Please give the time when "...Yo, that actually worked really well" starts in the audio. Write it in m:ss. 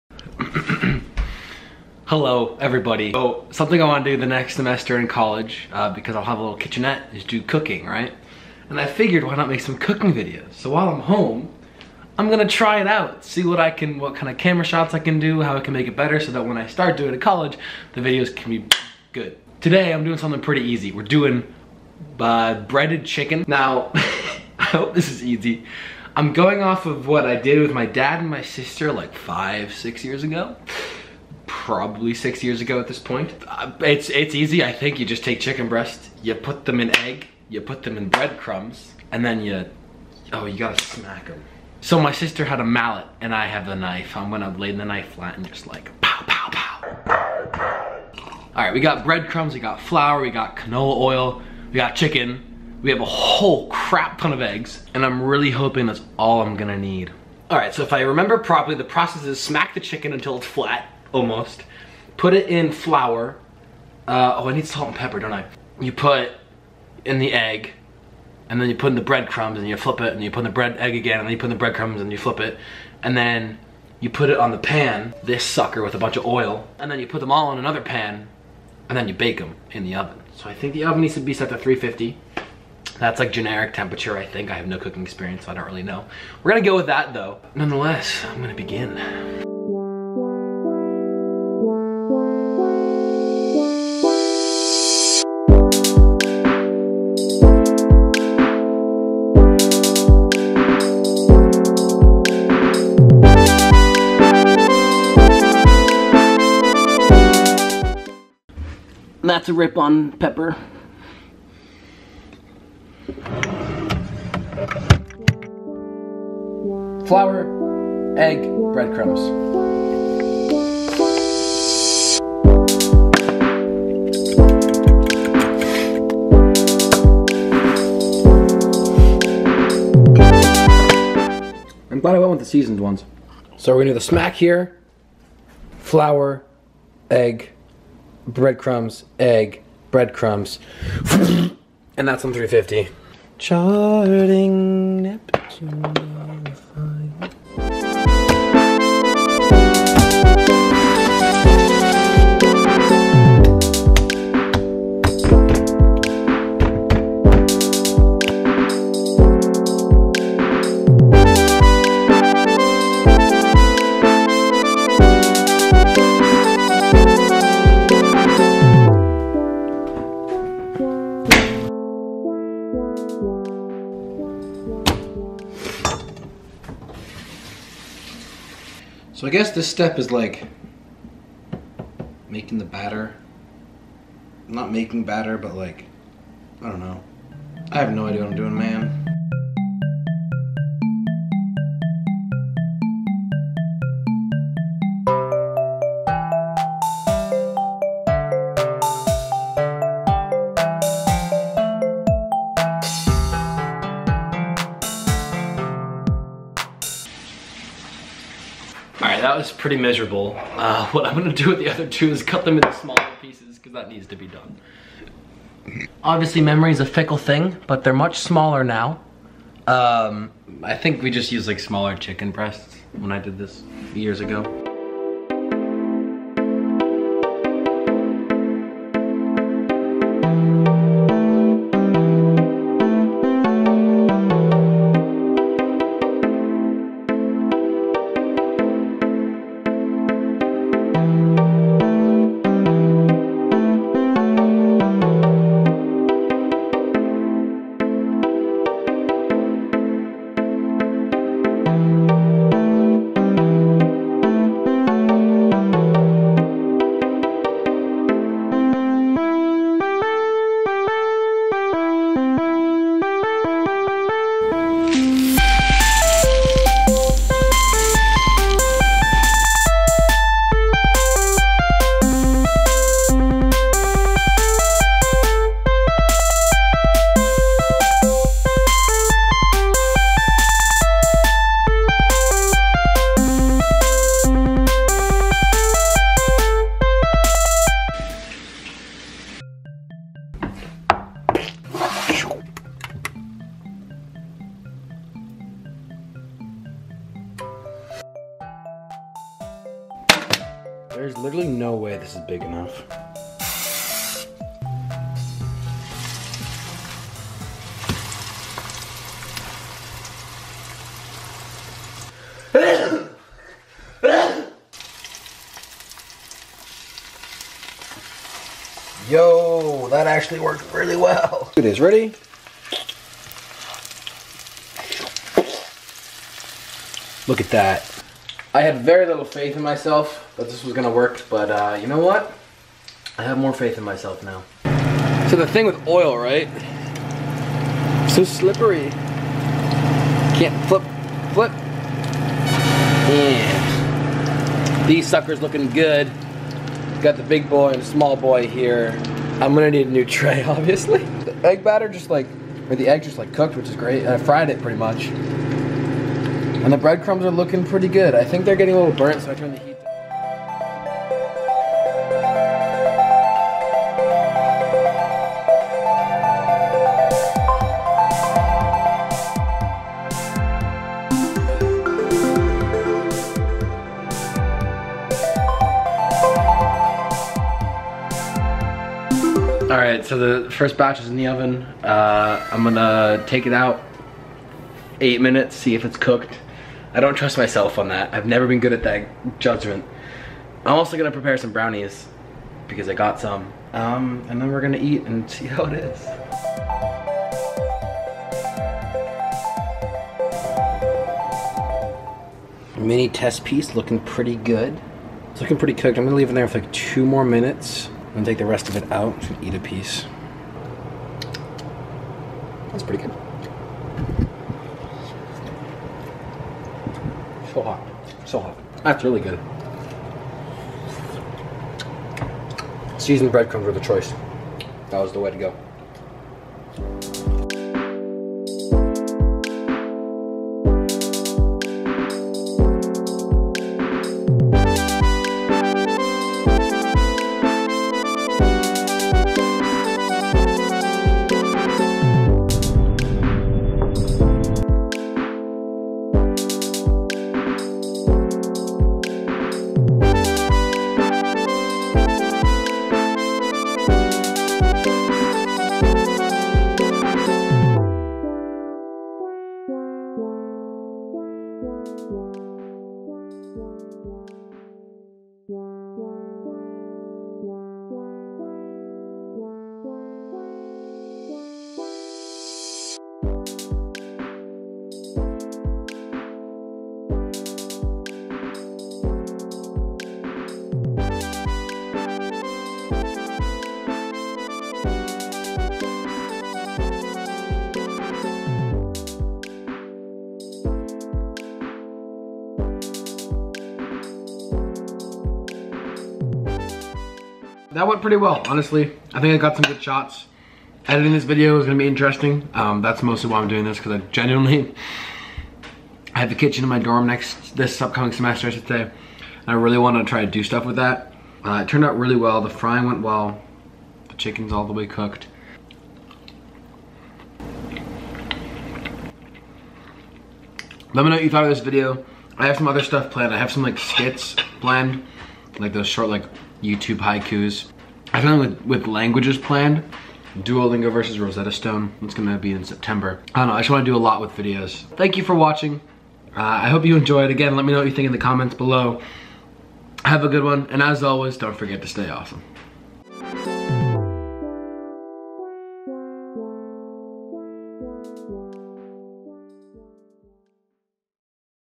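5:19.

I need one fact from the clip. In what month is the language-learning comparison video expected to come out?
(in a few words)
September.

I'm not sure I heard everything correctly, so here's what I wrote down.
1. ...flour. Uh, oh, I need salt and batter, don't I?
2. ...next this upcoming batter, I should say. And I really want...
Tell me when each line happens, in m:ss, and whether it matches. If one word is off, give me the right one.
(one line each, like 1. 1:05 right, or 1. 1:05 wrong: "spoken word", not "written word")
1. 1:02 wrong: "pepper", not "batter"
2. 8:27 wrong: "semester", not "batter".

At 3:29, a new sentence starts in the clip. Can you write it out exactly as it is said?
All right, that was pretty miserable.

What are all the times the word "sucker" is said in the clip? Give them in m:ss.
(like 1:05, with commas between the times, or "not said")
1:15, 5:45.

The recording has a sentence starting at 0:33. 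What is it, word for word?
Uh, it's, it's easy, I think.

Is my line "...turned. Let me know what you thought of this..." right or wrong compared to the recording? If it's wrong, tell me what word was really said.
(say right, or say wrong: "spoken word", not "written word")
wrong: "cooked", not "turned".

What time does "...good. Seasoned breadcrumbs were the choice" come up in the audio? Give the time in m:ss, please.
6:59.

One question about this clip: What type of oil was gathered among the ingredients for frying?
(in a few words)
Canola oil.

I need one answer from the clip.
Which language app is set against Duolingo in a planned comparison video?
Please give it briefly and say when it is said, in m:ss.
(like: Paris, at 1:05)
Rosetta Stone, at 8:51.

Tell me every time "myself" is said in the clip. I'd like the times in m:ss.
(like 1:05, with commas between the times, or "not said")
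5:29, 5:33, 6:27.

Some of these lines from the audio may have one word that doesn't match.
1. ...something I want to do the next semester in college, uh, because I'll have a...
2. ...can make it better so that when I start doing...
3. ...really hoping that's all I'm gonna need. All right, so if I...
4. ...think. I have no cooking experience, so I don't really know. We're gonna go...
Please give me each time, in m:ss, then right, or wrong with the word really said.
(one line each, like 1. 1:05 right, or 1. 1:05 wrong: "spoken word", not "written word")
1. 0:03 right
2. 0:15 right
3. 0:55 right
4. 1:24 right.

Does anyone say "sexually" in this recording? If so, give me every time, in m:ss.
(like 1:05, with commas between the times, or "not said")
not said.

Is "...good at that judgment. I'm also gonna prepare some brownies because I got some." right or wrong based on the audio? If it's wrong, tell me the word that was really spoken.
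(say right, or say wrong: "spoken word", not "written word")
right.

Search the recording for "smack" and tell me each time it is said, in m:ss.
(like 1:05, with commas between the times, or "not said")
0:40, 0:59, 2:13.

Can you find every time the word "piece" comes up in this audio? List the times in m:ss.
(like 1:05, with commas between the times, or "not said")
3:33, 6:43, 6:49.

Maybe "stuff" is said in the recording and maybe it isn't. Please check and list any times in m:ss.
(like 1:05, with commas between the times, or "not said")
8:30, 8:42.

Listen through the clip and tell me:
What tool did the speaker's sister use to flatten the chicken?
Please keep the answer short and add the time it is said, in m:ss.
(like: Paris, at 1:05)
Mallet, at 0:42.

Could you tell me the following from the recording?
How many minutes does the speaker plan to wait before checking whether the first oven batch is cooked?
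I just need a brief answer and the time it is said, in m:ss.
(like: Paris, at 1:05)
8, at 6:24.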